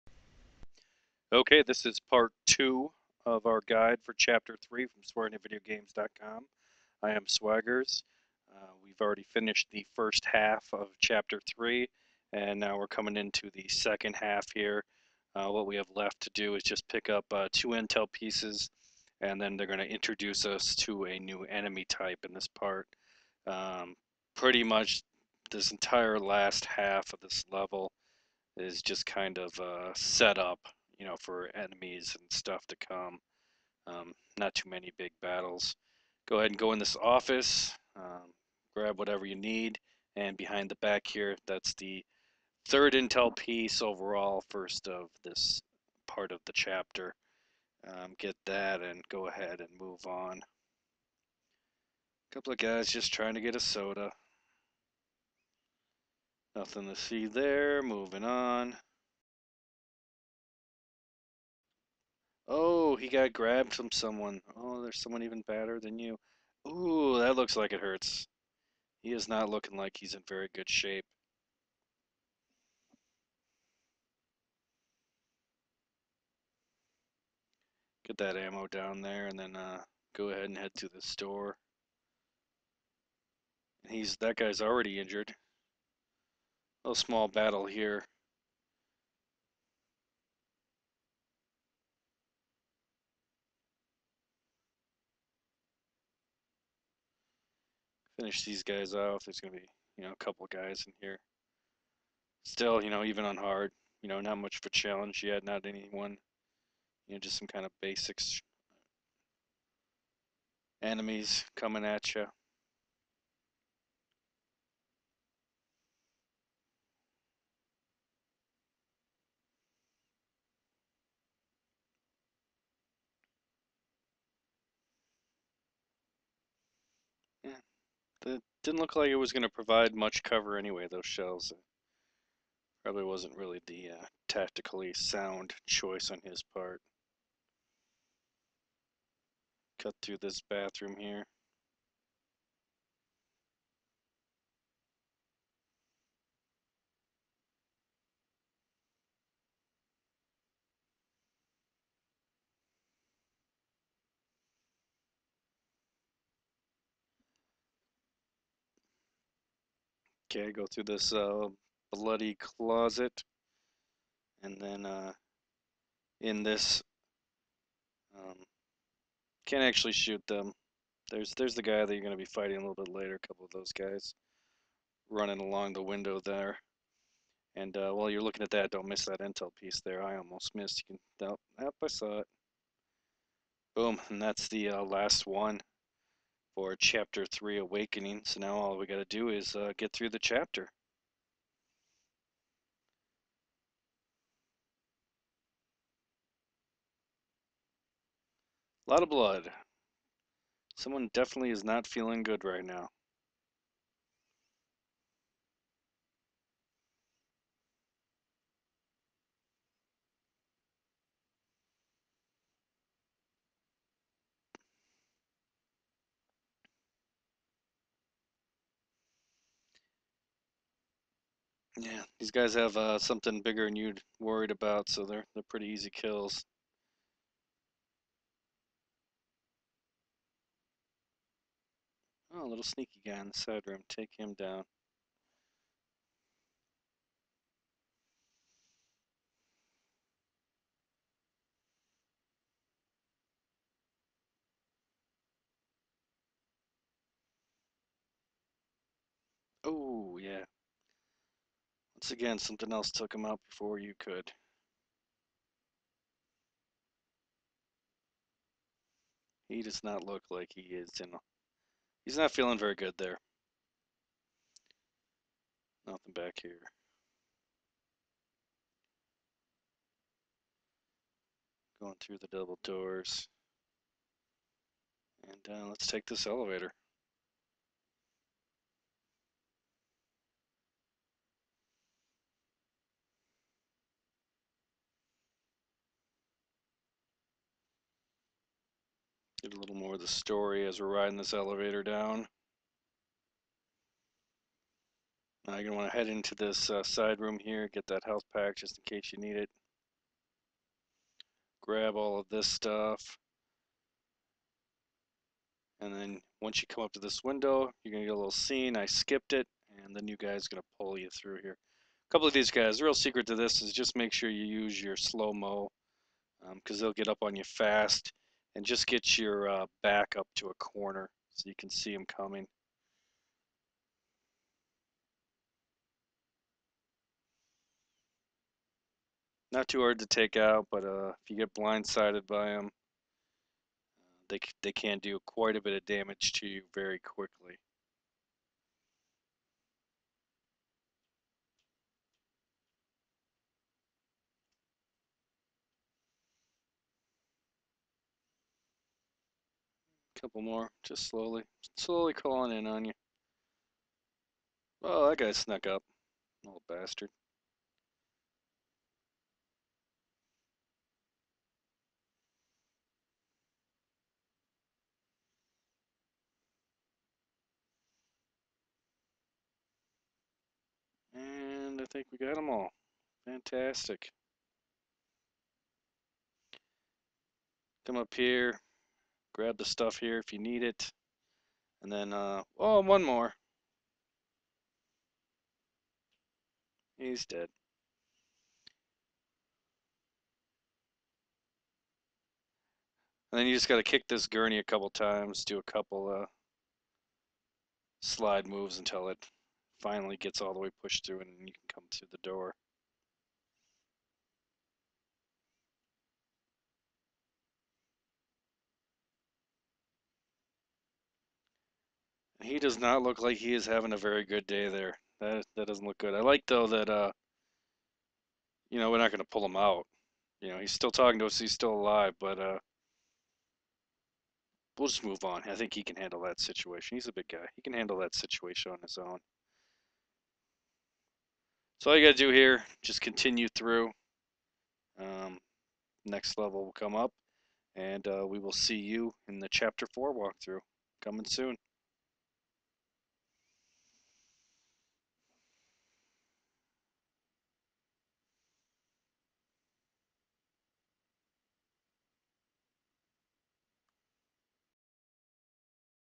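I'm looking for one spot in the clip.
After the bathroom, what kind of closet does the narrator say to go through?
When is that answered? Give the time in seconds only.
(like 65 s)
161 s.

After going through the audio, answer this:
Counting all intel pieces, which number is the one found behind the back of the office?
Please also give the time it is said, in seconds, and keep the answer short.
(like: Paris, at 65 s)
third, at 42 s.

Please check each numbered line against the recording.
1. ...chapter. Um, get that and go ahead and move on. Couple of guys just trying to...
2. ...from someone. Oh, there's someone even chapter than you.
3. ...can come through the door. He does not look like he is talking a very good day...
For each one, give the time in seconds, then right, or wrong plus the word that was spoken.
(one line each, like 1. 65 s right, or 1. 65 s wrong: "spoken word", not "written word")
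1. 46 s right
2. 63 s wrong: "badder", not "chapter"
3. 401 s wrong: "having", not "talking".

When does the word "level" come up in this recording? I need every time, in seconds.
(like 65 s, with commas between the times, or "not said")
27 s, 436 s.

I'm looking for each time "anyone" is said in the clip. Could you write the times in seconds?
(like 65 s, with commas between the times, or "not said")
105 s.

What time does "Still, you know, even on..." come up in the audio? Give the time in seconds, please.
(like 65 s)
102 s.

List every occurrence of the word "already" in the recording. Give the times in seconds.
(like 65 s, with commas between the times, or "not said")
8 s, 84 s.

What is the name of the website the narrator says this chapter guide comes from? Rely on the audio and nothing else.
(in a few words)
swearingatvideogames.com.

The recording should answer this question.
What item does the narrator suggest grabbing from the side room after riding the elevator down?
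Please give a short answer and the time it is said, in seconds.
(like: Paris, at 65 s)
health pack, at 298 s.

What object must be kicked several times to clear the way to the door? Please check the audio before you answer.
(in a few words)
gurney.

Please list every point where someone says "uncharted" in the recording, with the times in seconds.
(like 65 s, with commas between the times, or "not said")
not said.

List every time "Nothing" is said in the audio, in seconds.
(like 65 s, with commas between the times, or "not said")
56 s, 265 s.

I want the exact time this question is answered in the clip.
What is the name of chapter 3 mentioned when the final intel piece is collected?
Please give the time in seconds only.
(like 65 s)
187 s.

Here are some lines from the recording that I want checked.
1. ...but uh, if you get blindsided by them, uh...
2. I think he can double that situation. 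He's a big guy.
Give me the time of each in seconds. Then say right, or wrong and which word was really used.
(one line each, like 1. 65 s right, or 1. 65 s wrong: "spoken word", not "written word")
1. 330 s right
2. 425 s wrong: "handle", not "double".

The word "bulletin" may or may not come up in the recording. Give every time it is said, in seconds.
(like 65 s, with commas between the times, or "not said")
not said.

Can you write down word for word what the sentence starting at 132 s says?
Probably wasn't really the uh, tactically sound choice on his part.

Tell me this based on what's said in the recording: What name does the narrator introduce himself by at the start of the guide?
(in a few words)
Swaggers.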